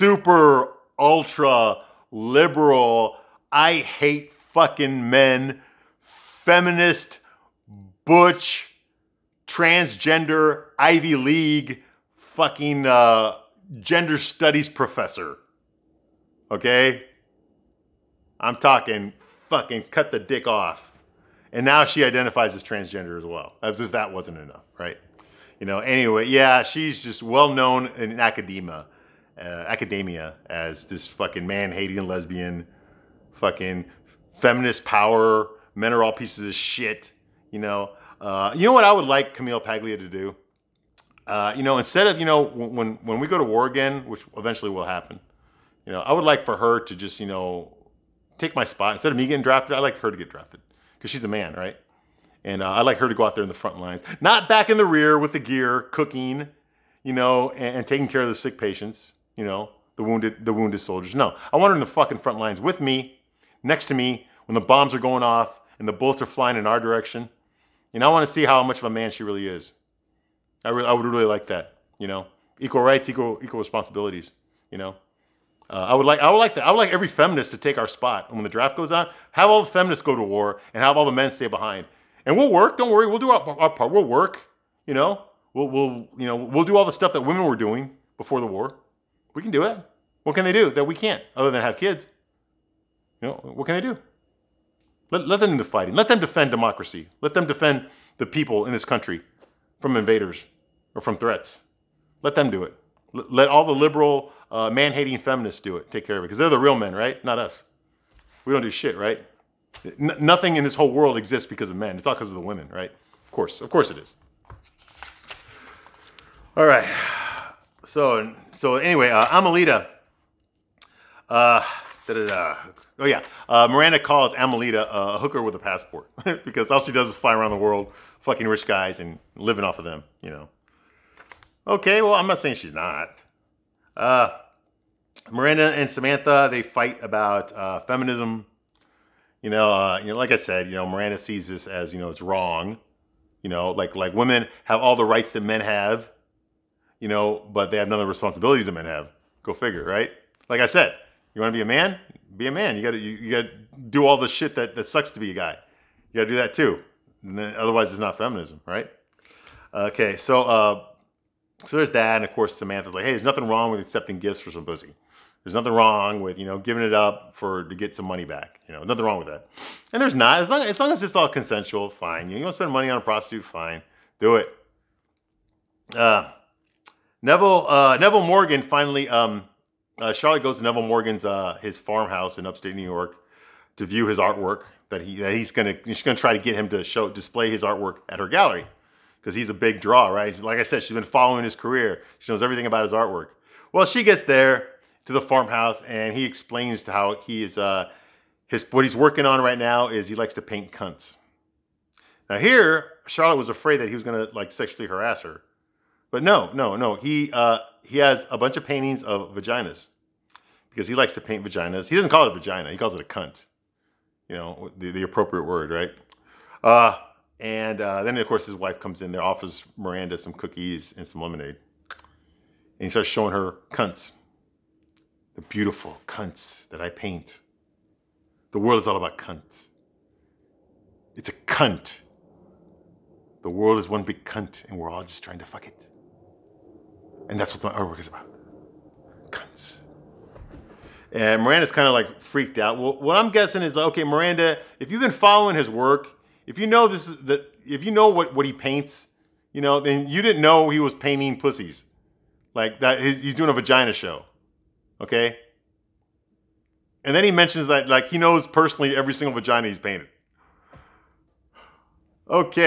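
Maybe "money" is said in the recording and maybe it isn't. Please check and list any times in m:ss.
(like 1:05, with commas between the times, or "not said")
2:48, 2:52.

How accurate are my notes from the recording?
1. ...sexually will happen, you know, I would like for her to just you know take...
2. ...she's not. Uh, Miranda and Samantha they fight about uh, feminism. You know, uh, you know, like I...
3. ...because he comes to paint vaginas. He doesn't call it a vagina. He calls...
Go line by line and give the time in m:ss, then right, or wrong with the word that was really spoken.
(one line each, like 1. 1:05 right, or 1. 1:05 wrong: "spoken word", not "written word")
1. 0:44 wrong: "eventually", not "sexually"
2. 2:12 right
3. 3:30 wrong: "likes", not "comes".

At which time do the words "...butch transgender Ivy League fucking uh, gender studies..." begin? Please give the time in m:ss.
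0:08.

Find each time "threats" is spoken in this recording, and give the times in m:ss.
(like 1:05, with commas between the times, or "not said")
1:41.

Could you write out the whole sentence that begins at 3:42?
And he starts showing her cunts, the beautiful cunts that I paint.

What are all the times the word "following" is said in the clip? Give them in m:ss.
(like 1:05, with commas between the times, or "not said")
3:11, 4:05.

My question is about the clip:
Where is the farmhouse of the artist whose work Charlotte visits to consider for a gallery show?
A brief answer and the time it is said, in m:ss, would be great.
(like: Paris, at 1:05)
upstate New York, at 3:02.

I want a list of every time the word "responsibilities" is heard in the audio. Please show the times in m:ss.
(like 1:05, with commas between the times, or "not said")
1:13, 2:28.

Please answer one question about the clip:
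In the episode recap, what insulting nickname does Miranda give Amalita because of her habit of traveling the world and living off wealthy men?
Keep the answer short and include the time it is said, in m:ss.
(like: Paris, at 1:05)
hooker with a passport, at 2:05.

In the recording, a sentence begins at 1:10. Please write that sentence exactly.
I, re- I would really like that.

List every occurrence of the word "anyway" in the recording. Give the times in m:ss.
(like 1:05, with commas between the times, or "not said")
0:25, 1:58.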